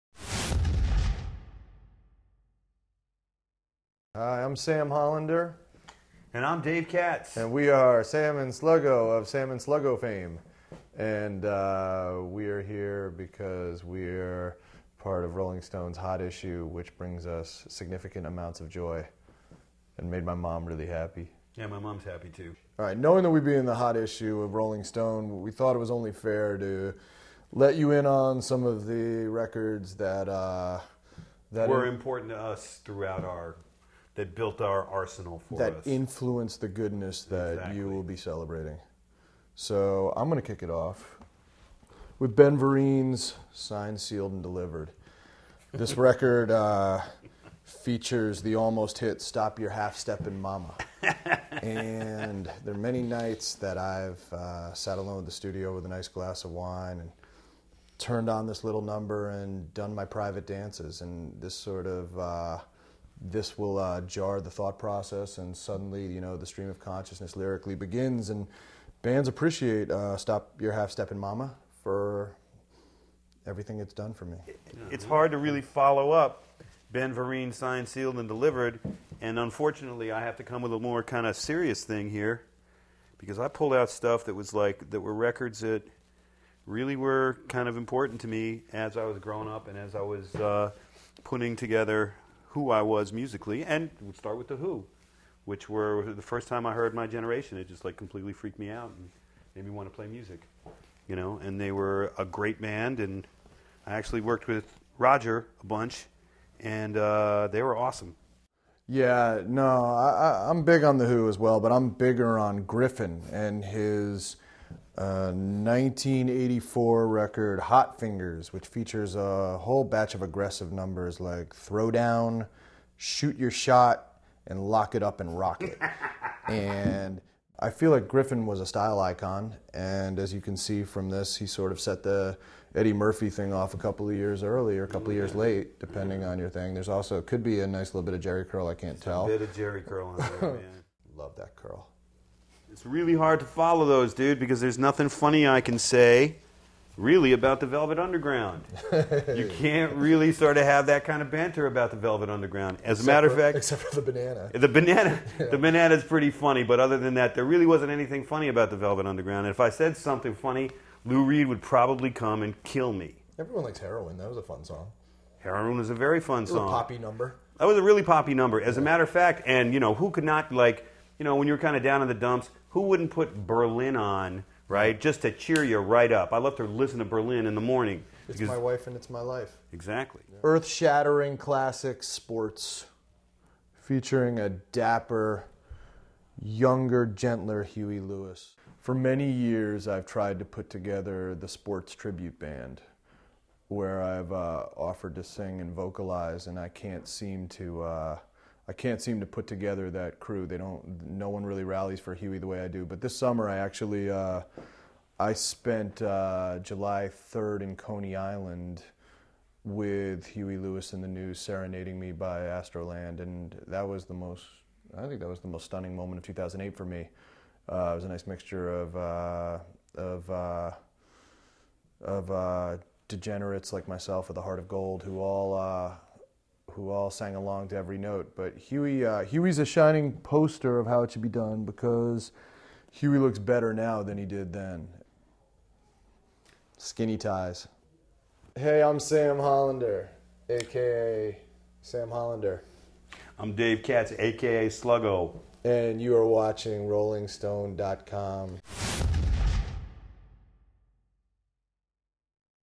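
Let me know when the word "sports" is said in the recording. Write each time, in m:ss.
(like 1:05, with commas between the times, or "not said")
3:02, 3:11.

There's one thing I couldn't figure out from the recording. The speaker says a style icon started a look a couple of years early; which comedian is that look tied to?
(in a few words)
Eddie Murphy.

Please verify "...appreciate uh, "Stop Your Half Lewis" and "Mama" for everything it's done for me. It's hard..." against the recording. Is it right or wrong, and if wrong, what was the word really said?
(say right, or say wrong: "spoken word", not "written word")
wrong: "Step", not "Lewis".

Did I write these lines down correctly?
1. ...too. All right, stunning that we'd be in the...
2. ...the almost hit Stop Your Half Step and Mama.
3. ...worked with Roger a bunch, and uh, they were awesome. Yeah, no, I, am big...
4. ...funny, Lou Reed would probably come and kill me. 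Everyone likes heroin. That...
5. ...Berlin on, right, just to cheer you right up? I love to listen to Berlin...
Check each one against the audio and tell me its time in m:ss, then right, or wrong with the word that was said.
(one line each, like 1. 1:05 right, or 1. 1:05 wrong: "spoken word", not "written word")
1. 0:22 wrong: "knowing", not "stunning"
2. 0:48 right
3. 1:44 right
4. 2:40 right
5. 2:53 right.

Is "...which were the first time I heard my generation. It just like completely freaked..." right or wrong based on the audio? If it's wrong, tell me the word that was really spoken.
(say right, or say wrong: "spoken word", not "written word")
right.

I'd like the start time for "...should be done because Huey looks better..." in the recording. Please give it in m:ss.
3:51.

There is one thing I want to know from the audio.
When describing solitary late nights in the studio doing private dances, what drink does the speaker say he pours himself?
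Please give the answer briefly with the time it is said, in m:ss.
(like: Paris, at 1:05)
wine, at 0:56.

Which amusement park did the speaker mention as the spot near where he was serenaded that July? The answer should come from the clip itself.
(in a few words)
Astroland.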